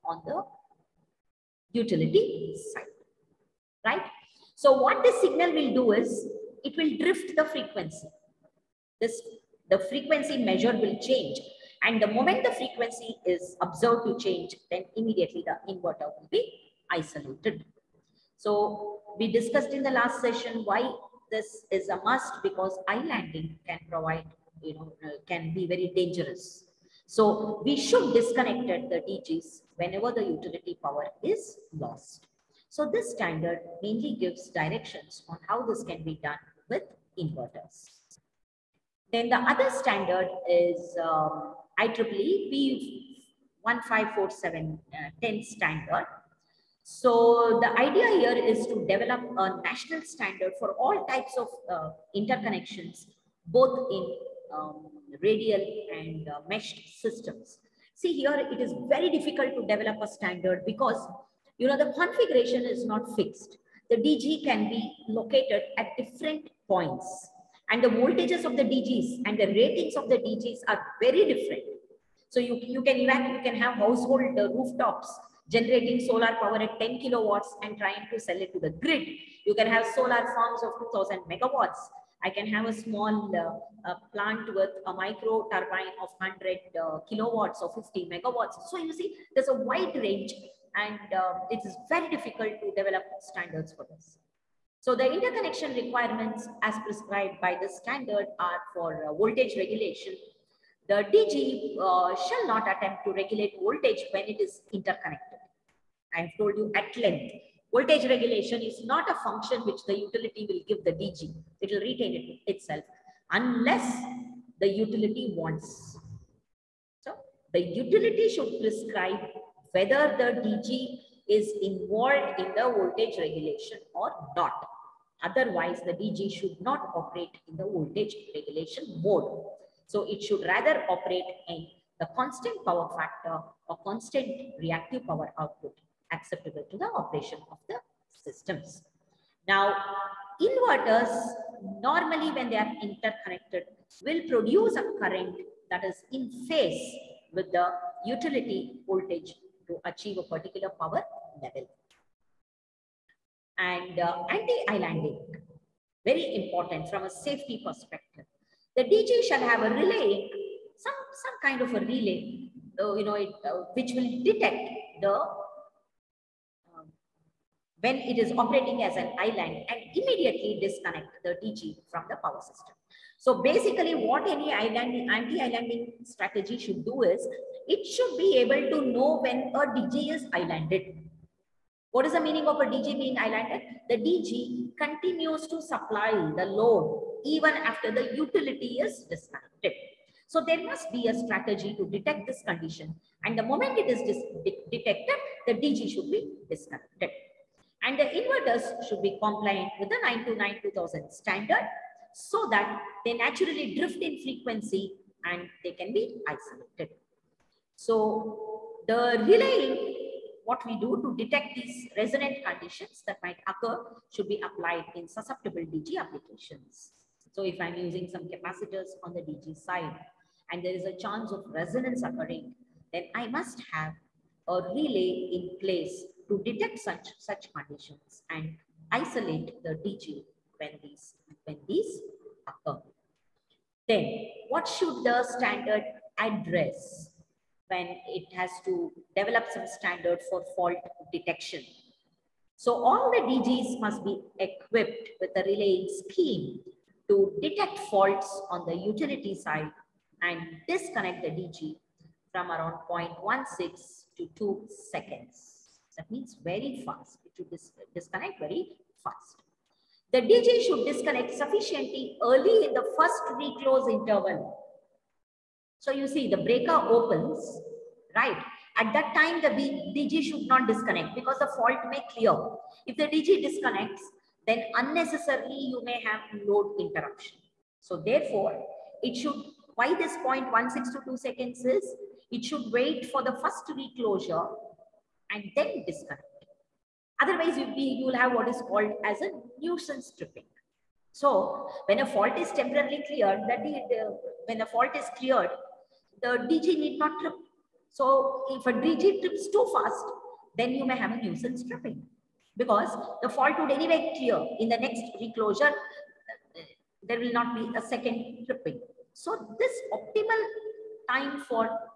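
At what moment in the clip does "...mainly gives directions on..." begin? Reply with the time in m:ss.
0:33.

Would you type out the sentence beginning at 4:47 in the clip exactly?
Otherwise, you will have what is called as a nuisance tripping.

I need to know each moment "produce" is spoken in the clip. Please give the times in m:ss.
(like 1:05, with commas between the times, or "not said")
2:24.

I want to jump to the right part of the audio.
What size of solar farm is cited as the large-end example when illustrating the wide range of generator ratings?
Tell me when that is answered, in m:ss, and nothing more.
1:20.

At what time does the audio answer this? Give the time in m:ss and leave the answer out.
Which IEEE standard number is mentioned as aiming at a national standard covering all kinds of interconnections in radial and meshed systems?
0:41.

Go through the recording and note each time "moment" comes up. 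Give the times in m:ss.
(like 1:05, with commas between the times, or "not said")
0:12, 3:13.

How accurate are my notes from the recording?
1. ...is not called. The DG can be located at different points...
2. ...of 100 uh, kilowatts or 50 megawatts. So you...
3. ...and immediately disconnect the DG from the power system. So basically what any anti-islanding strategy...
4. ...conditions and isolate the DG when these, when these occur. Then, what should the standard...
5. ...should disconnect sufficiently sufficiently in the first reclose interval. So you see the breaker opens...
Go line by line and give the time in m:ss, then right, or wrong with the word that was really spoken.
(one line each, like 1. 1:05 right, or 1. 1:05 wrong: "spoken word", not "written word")
1. 1:02 wrong: "fixed", not "called"
2. 1:26 right
3. 2:49 right
4. 3:47 right
5. 4:20 wrong: "early", not "sufficiently".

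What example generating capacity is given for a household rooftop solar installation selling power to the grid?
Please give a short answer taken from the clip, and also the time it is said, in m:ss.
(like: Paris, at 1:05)
10 kilowatts, at 1:16.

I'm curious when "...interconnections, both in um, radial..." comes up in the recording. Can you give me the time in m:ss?
0:52.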